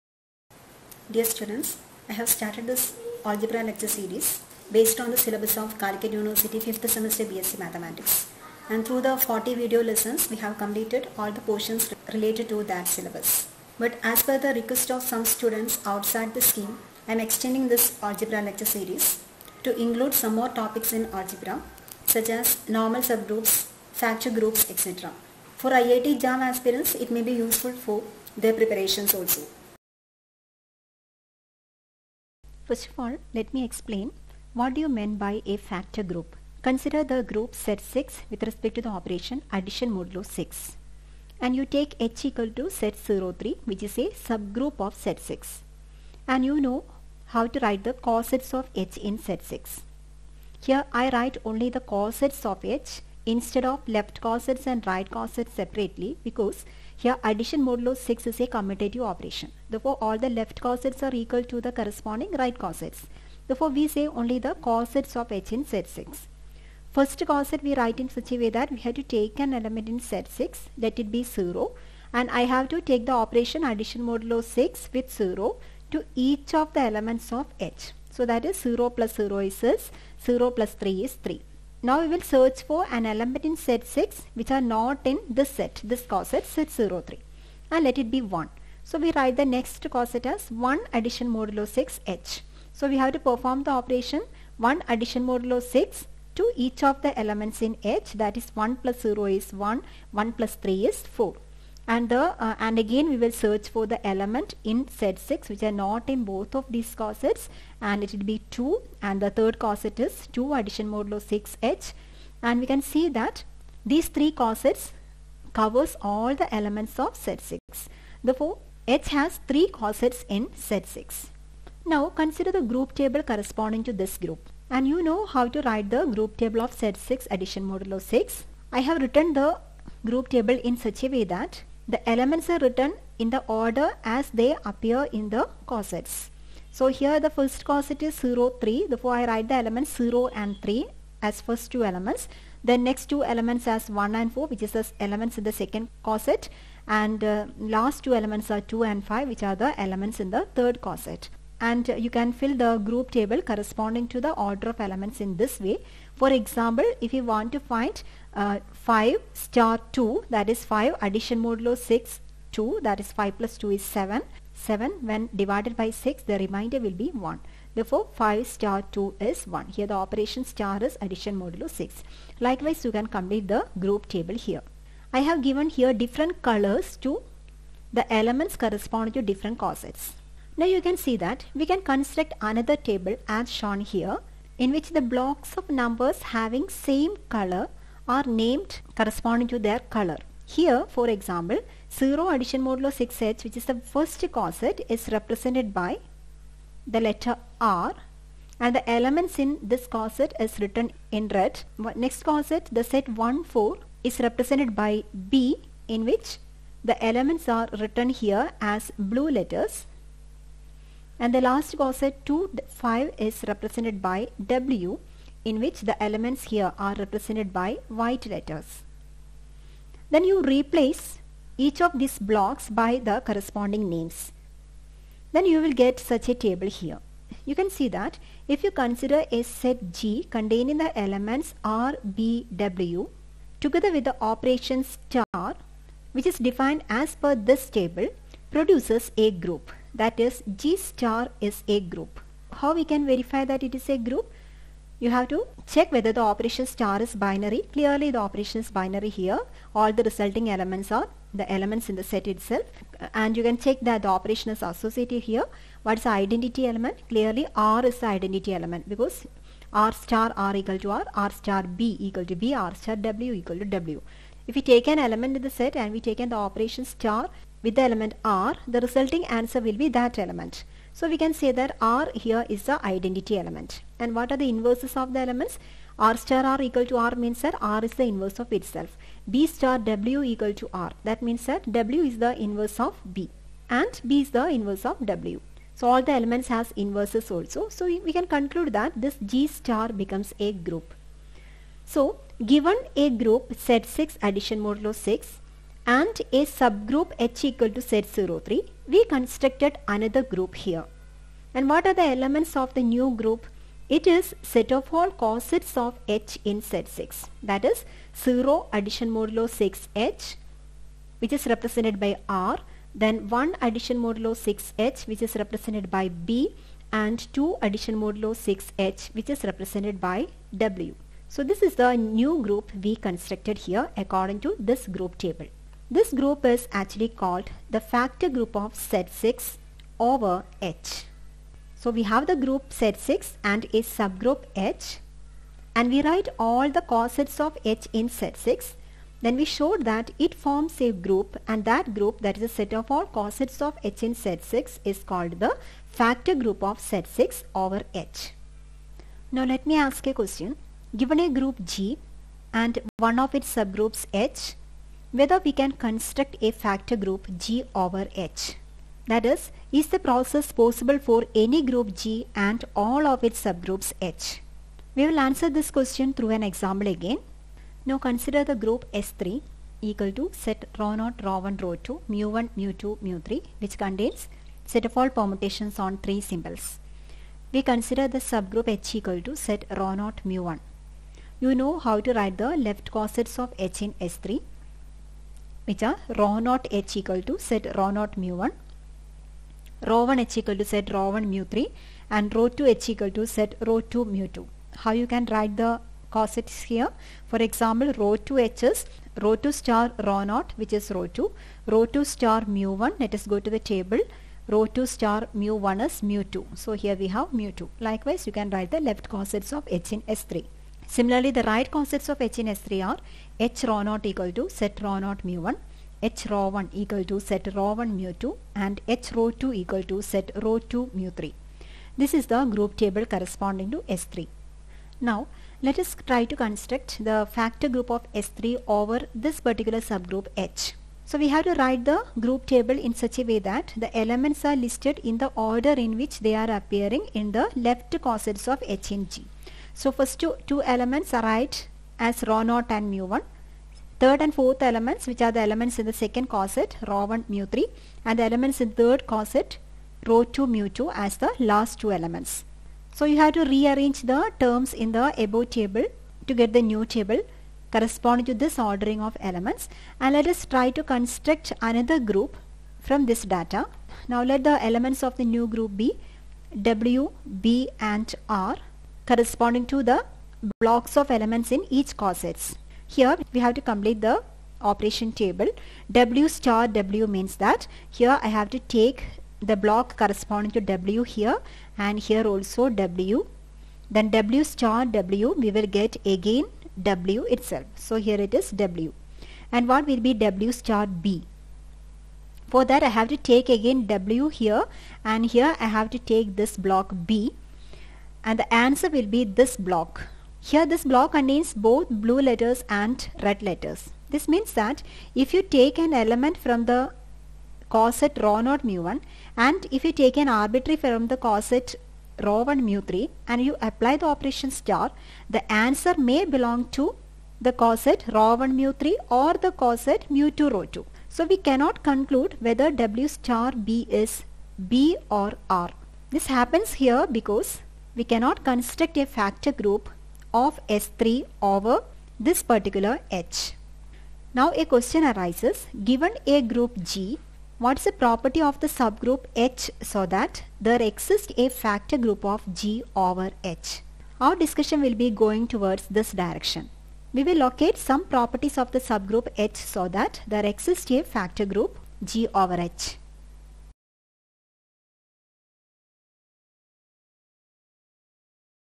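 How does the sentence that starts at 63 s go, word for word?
Therefore we say only the cosets of H in Z6.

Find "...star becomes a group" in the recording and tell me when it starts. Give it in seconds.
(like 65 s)
289 s.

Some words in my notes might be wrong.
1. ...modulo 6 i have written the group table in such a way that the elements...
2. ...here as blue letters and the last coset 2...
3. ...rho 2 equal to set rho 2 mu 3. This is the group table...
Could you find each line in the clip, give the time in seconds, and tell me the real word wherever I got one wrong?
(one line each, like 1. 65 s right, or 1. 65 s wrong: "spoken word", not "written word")
1. 127 s right
2. 208 s right
3. 419 s right.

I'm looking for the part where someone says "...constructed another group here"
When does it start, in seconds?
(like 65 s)
299 s.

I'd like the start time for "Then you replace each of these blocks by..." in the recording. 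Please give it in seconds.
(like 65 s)
220 s.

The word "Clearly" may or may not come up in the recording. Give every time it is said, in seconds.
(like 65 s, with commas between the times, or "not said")
247 s, 257 s.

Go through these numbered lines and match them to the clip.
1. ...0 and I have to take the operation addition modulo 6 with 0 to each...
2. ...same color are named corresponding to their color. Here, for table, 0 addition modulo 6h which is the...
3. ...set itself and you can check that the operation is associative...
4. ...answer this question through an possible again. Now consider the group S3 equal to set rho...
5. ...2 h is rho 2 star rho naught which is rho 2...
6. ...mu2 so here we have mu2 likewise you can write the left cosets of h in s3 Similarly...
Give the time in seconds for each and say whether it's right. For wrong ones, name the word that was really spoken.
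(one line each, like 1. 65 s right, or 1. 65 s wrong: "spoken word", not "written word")
1. 71 s right
2. 186 s wrong: "example", not "table"
3. 252 s right
4. 365 s wrong: "example", not "possible"
5. 398 s right
6. 406 s right.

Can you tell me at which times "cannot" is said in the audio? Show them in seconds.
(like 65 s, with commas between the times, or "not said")
521 s, 528 s.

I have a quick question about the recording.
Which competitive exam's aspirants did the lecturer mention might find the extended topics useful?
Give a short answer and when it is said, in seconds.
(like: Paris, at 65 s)
IIT JAM, at 25 s.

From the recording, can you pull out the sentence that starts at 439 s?
So first two, two elements are right as rho naught and mu1.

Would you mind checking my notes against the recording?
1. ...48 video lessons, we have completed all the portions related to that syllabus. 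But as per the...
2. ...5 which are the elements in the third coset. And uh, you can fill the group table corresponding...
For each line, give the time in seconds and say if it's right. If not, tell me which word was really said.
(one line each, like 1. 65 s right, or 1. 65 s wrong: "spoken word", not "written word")
1. 9 s wrong: "40", not "48"
2. 149 s right.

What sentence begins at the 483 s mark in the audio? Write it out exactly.
Then W star W we will get again W itself.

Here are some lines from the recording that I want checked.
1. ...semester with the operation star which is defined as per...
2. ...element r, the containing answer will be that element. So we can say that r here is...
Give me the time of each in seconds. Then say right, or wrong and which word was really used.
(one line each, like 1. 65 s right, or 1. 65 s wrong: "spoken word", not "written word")
1. 233 s wrong: "together", not "semester"
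2. 267 s wrong: "resulting", not "containing".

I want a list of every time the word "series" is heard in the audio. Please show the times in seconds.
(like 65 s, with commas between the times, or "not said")
3 s, 18 s.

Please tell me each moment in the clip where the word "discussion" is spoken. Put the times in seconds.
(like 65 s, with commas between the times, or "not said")
544 s.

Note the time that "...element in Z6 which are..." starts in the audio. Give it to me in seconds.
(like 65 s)
83 s.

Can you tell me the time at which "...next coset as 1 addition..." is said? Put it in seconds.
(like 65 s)
89 s.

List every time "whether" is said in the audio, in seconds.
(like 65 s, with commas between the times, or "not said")
245 s, 355 s, 522 s.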